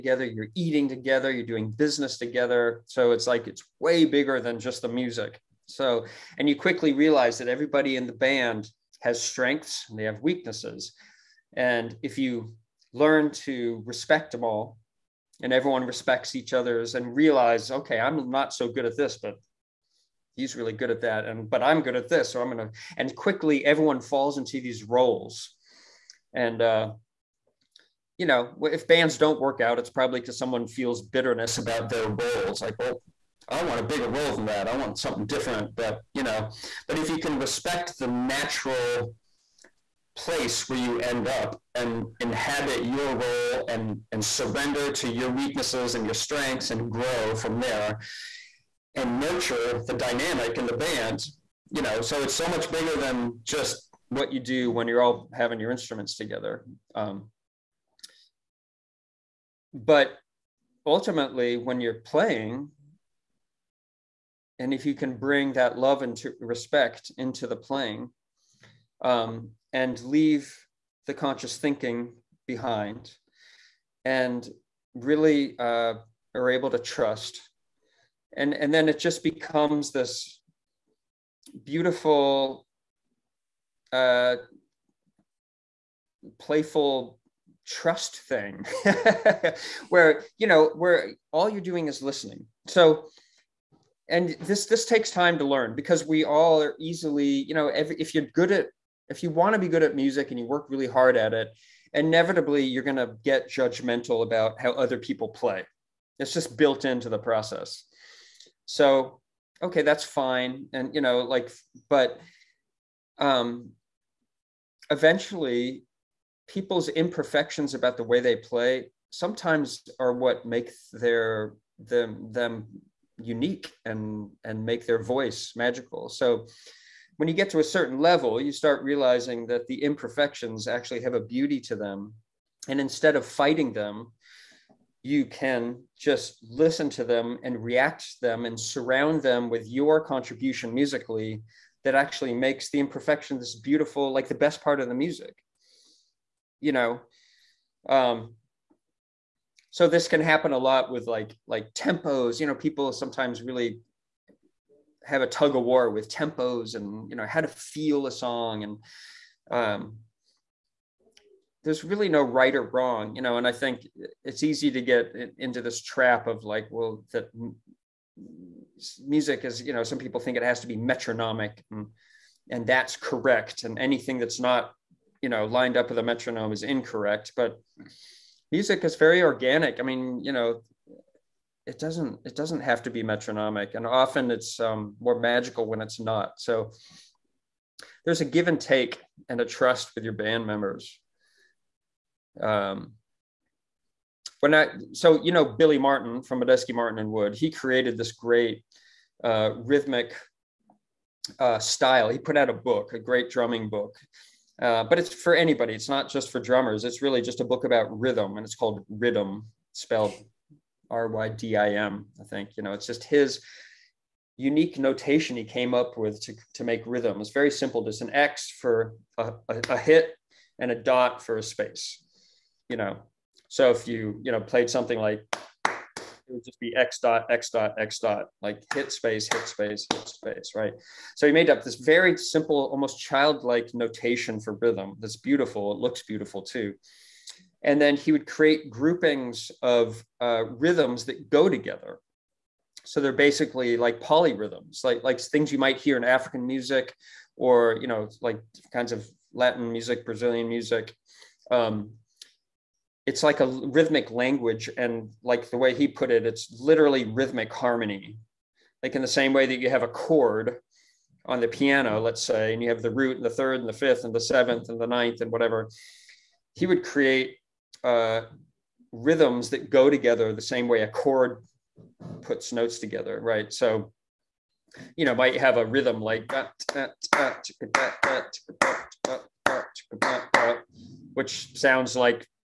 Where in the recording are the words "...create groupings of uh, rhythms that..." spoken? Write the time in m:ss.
3:58.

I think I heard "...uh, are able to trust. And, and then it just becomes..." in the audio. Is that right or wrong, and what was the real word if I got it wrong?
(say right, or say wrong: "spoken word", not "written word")
right.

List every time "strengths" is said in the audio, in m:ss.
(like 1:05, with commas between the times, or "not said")
0:09, 0:46.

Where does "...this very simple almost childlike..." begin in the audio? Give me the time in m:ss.
3:51.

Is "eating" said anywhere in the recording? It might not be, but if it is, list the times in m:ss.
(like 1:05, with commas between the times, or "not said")
0:00.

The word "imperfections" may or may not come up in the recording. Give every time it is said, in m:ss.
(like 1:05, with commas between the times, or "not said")
1:56, 2:09, 2:22.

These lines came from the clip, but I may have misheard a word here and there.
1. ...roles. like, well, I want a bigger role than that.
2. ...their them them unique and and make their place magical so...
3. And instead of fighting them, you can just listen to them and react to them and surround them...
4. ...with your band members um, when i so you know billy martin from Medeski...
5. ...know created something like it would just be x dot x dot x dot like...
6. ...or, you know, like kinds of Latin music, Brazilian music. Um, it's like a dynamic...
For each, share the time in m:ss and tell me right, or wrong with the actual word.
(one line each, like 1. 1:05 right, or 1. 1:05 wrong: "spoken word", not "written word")
1. 0:32 right
2. 2:00 wrong: "voice", not "place"
3. 2:12 right
4. 3:09 right
5. 3:44 wrong: "played", not "created"
6. 4:07 wrong: "rhythmic", not "dynamic".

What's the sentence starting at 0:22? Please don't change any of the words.
So I'm going to, and quickly everyone falls into these roles.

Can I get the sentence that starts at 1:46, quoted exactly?
It's just built into the process.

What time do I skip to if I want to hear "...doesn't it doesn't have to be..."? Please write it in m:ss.
3:01.